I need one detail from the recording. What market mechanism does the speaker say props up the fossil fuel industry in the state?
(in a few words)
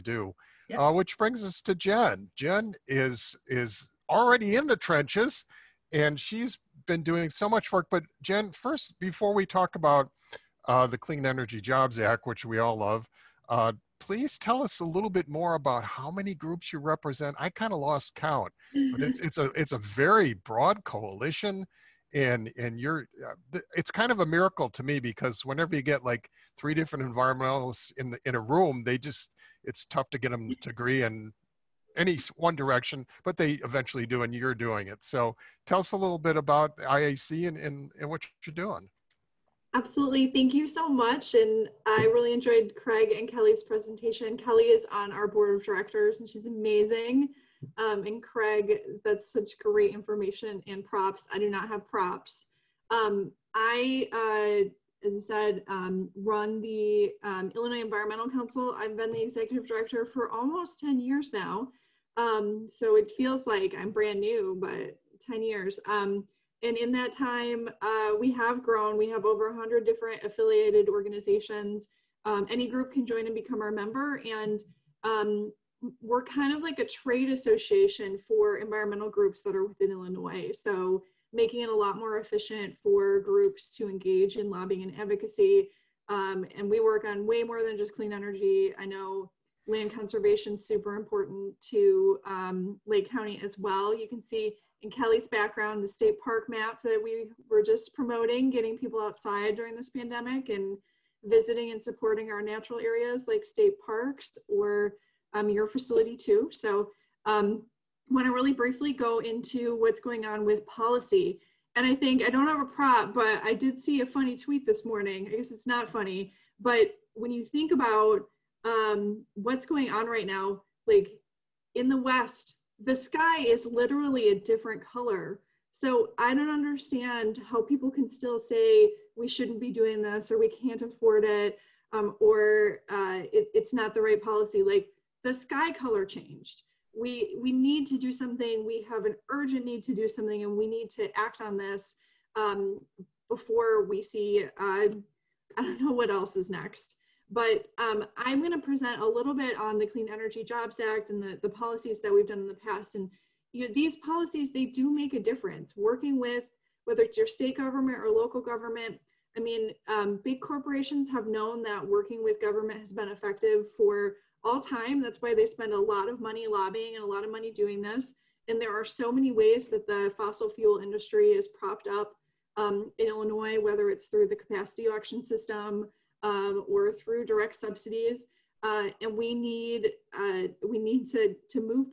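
capacity auction system.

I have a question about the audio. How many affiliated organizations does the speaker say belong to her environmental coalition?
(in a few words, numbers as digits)
over 100.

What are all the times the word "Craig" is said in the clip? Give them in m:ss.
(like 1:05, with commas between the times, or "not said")
0:42, 0:48.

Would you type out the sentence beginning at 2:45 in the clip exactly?
That's why they spend a lot of money lobbying and a lot of money doing this.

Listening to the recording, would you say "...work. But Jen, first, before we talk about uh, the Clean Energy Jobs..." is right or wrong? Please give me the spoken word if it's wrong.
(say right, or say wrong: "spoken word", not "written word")
right.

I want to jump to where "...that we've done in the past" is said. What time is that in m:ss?
2:32.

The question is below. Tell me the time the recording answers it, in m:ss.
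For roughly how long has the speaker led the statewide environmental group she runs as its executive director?
1:00.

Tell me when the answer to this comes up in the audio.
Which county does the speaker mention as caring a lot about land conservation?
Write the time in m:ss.
1:32.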